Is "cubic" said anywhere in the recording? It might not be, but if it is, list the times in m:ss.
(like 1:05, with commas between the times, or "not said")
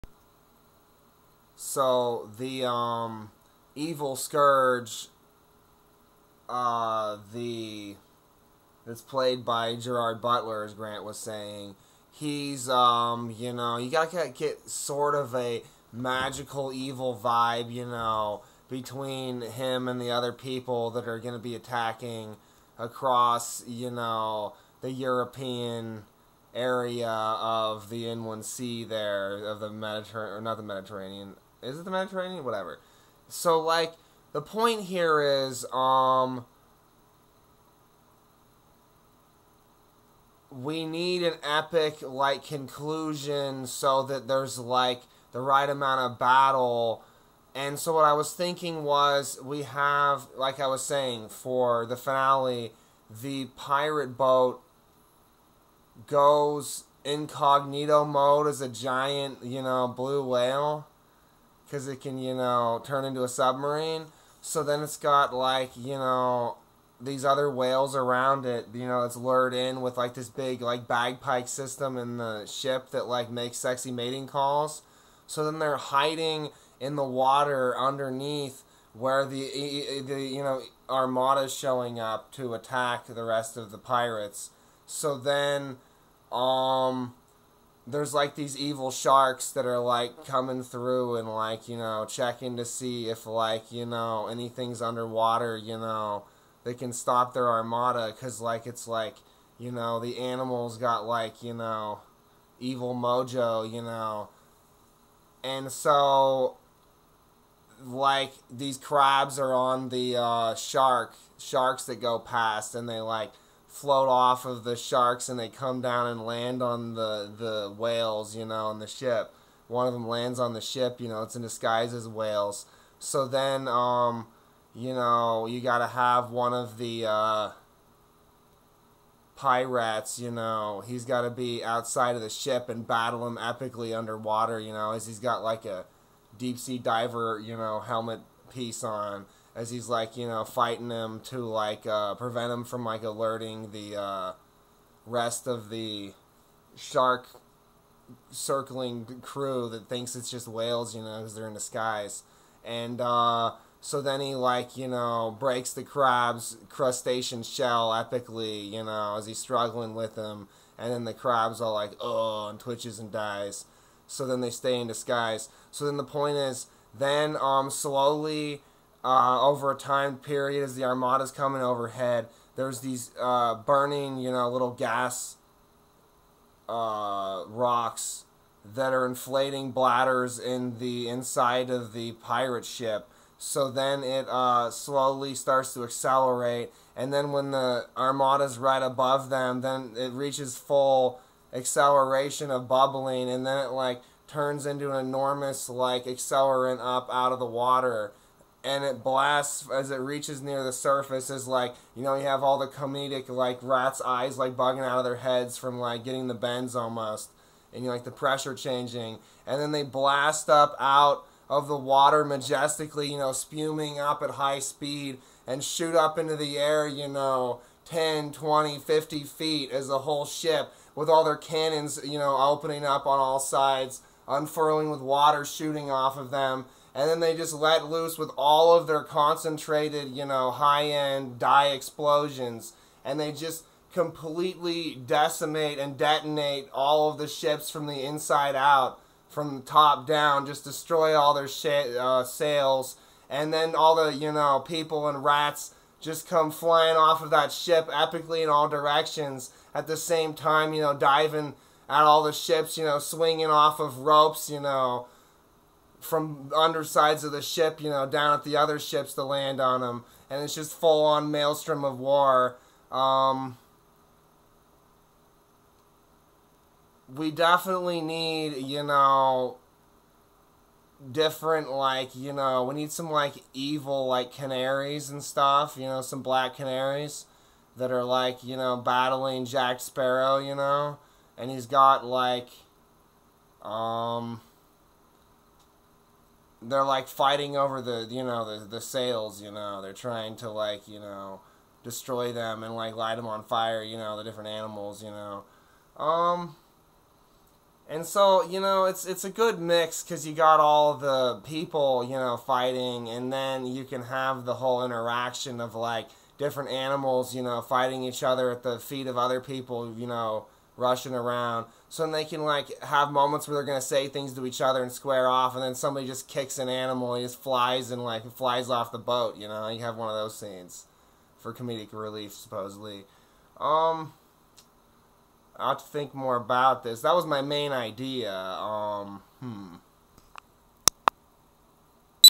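not said.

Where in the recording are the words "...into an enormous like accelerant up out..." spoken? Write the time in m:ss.
3:14.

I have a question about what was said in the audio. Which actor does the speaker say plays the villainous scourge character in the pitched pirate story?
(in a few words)
Gerard Butler.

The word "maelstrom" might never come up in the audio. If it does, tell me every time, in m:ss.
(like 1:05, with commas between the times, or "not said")
4:21.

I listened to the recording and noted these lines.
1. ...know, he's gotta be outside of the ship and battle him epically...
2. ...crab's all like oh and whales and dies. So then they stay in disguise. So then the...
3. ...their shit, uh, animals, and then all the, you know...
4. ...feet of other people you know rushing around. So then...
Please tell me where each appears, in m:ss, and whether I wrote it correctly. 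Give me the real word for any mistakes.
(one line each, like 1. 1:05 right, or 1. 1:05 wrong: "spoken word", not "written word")
1. 2:10 right
2. 2:41 wrong: "twitches", not "whales"
3. 4:01 wrong: "sails", not "animals"
4. 5:08 right.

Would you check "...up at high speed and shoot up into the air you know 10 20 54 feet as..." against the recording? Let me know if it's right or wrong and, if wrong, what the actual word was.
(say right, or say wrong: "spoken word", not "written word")
wrong: "50", not "54".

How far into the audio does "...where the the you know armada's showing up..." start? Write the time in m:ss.
1:18.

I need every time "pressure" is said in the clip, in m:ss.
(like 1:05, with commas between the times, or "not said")
3:28.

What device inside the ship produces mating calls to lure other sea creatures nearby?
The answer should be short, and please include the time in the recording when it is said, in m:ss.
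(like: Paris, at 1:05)
bagpipe system, at 1:10.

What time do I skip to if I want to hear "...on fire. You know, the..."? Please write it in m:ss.
4:53.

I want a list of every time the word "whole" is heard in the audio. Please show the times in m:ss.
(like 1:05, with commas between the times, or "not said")
3:39, 5:04.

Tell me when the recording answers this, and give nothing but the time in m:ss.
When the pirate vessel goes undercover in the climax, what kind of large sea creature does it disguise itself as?
0:59.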